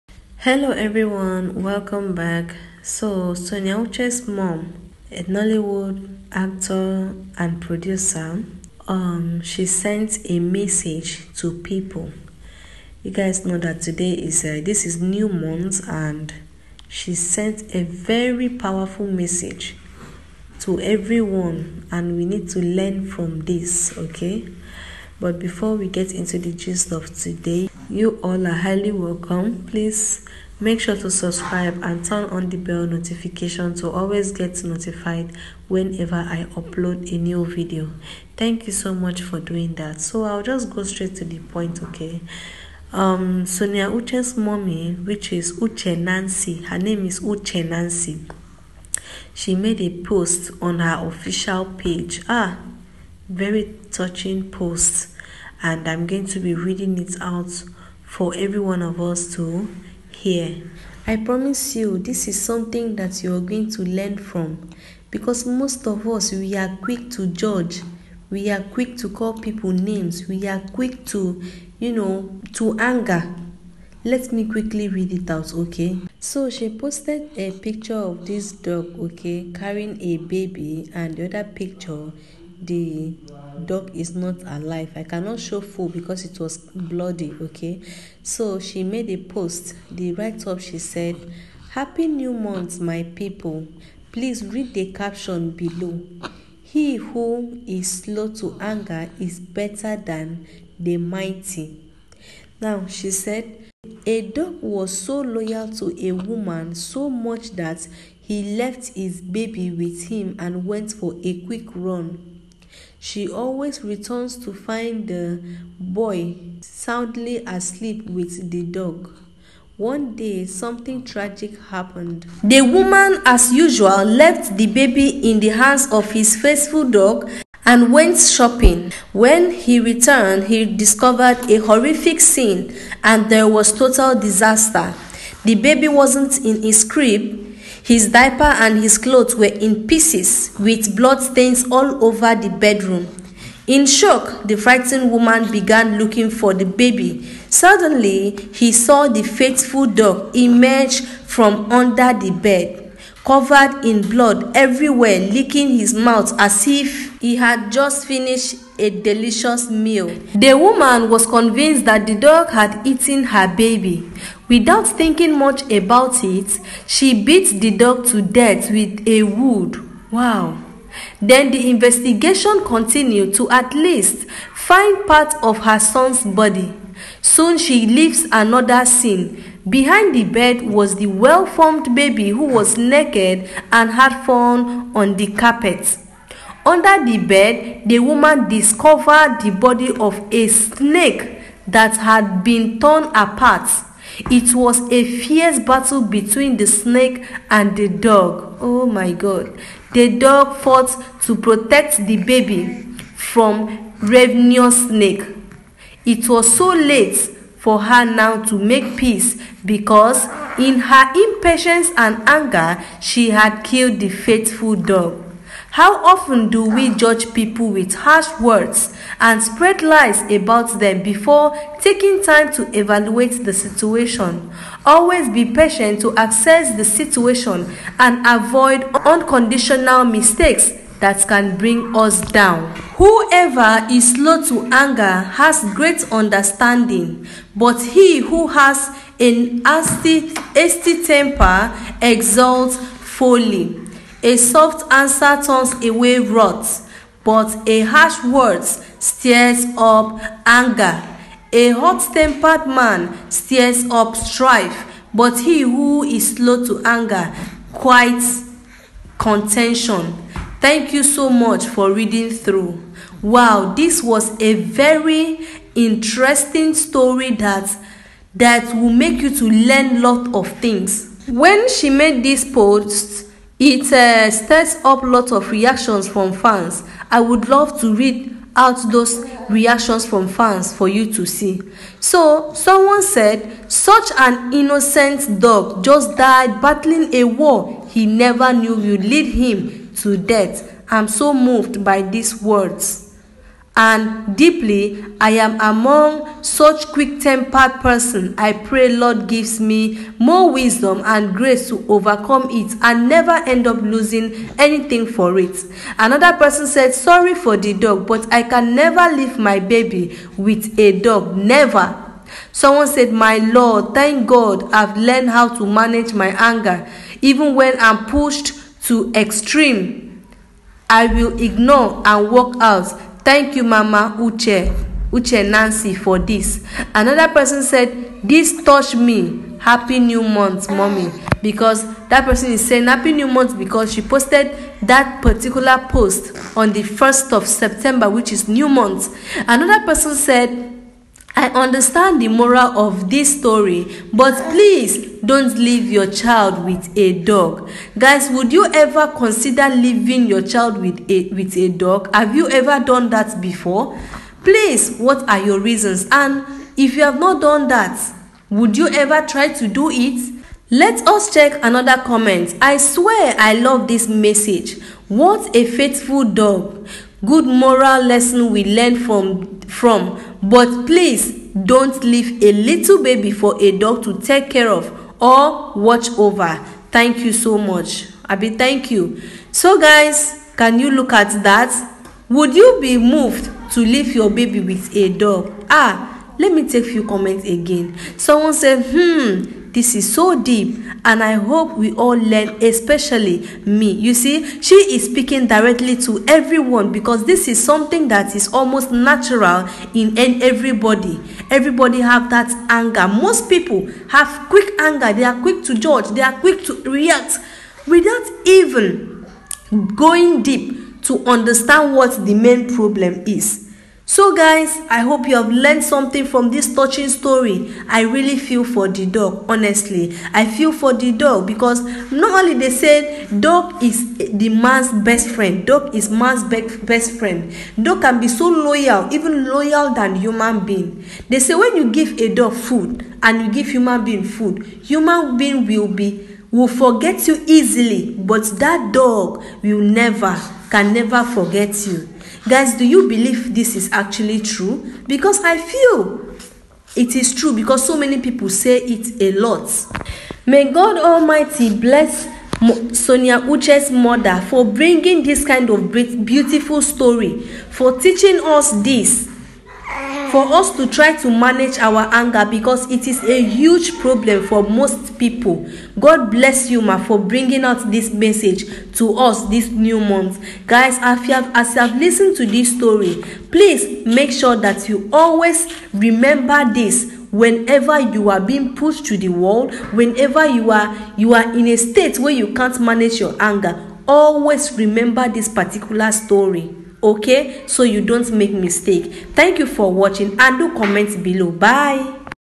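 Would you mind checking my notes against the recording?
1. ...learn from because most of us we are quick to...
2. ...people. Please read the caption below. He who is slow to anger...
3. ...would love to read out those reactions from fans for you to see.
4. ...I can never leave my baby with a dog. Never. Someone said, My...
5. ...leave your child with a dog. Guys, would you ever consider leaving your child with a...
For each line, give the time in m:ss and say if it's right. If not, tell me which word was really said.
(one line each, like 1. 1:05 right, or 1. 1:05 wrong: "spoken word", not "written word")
1. 1:03 right
2. 1:33 right
3. 4:37 right
4. 5:08 right
5. 5:45 right.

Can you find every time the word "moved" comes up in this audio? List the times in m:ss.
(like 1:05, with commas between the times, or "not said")
4:51, 6:22.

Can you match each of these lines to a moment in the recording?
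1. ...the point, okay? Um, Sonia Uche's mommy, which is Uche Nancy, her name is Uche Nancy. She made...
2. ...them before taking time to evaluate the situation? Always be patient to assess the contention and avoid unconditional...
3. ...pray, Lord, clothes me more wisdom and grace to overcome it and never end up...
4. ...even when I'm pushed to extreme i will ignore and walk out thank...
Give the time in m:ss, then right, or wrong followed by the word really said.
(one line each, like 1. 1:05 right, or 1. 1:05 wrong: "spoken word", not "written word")
1. 0:41 right
2. 3:40 wrong: "situation", not "contention"
3. 4:58 wrong: "gives", not "clothes"
4. 5:17 right.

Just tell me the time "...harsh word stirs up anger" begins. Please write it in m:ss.
4:07.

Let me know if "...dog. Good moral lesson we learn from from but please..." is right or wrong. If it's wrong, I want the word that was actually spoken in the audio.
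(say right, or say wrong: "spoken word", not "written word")
right.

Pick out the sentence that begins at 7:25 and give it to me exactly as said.
Because I feel it is true because so many people say it a lot.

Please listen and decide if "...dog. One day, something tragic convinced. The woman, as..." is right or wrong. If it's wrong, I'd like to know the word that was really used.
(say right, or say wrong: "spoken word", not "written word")
wrong: "happened", not "convinced".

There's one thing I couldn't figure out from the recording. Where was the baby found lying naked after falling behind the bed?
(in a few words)
On the carpet.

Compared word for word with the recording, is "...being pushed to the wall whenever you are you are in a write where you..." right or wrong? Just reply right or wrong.
wrong.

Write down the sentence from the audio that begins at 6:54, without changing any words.
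So guys, I hope you have learned something from this touching story.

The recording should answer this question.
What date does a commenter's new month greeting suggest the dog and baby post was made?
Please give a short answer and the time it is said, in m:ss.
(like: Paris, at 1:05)
1 September, at 5:36.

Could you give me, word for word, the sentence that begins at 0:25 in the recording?
But before we get into the gist of today, you all are highly welcome.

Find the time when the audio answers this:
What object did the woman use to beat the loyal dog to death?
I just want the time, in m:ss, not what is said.
2:49.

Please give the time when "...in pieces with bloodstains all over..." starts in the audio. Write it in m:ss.
2:19.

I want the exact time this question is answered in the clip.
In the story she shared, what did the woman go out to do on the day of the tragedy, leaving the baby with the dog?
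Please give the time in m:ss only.
2:08.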